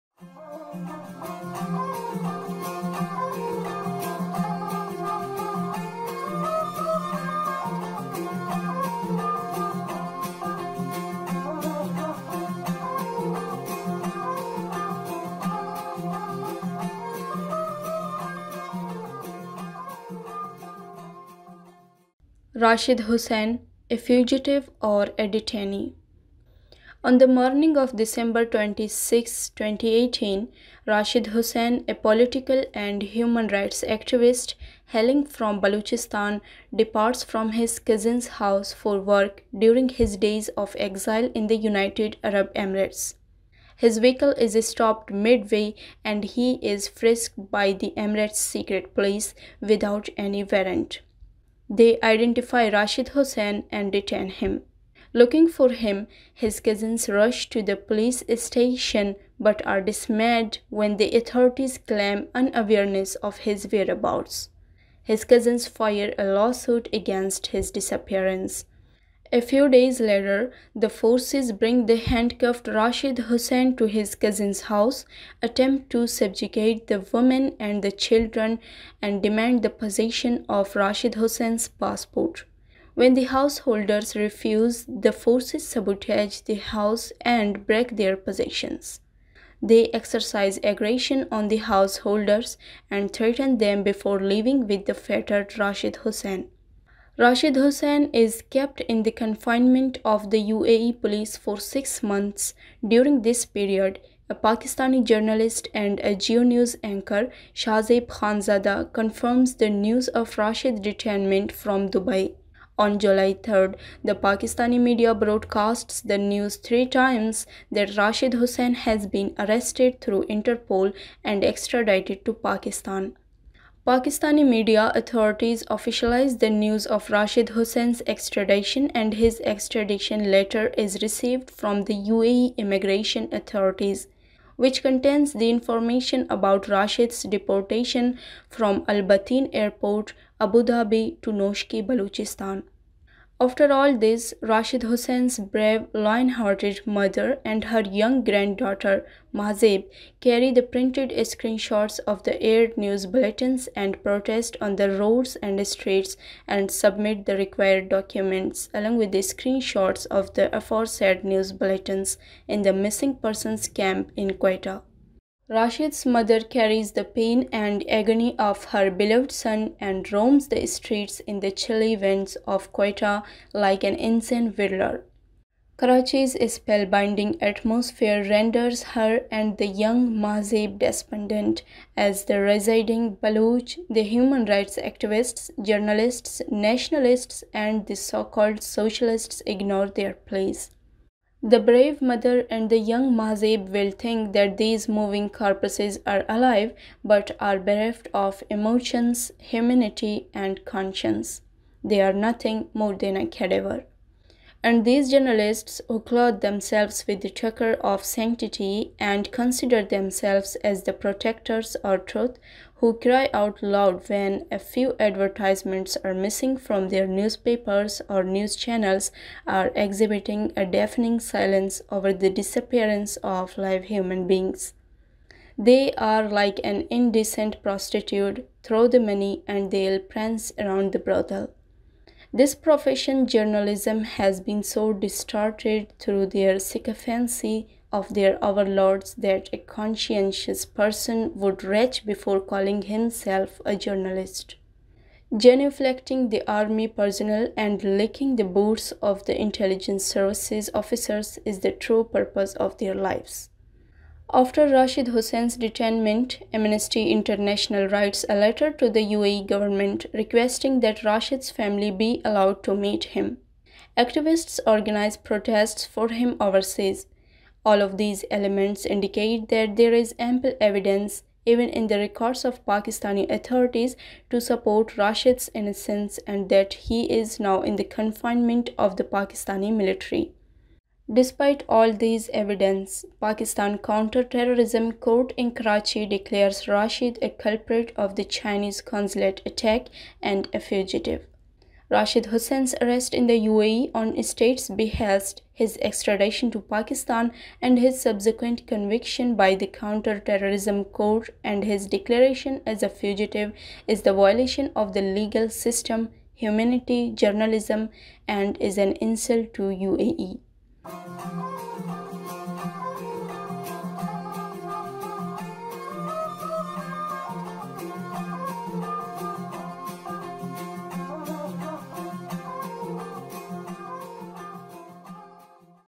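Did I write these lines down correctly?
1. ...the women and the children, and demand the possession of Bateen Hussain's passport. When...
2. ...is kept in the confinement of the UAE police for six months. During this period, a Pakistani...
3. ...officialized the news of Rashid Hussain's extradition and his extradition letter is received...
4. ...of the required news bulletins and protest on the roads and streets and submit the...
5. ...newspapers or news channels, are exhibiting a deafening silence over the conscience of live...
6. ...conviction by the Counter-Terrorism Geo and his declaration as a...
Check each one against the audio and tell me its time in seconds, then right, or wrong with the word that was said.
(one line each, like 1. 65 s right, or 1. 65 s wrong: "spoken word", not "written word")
1. 76 s wrong: "Rashid", not "Bateen"
2. 98 s right
3. 125 s right
4. 152 s wrong: "aired", not "required"
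5. 217 s wrong: "disappearance", not "conscience"
6. 298 s wrong: "Court", not "Geo".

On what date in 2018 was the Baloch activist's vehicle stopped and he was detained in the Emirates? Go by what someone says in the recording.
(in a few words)
December 26.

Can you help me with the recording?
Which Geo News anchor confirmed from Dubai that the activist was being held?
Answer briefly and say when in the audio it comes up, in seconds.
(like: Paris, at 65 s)
Shahzeb Khanzada, at 107 s.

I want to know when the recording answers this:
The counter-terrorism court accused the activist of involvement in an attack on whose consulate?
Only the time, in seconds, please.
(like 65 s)
288 s.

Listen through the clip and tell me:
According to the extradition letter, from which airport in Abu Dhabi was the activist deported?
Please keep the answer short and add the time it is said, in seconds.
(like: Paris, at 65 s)
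Al Bateen Airport, at 138 s.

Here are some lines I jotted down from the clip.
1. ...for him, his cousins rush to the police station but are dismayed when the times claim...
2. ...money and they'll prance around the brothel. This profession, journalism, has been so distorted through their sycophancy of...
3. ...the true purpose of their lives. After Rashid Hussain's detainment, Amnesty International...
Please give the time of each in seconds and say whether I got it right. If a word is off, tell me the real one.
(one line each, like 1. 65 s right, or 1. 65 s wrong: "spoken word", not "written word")
1. 55 s wrong: "authorities", not "times"
2. 228 s right
3. 251 s right.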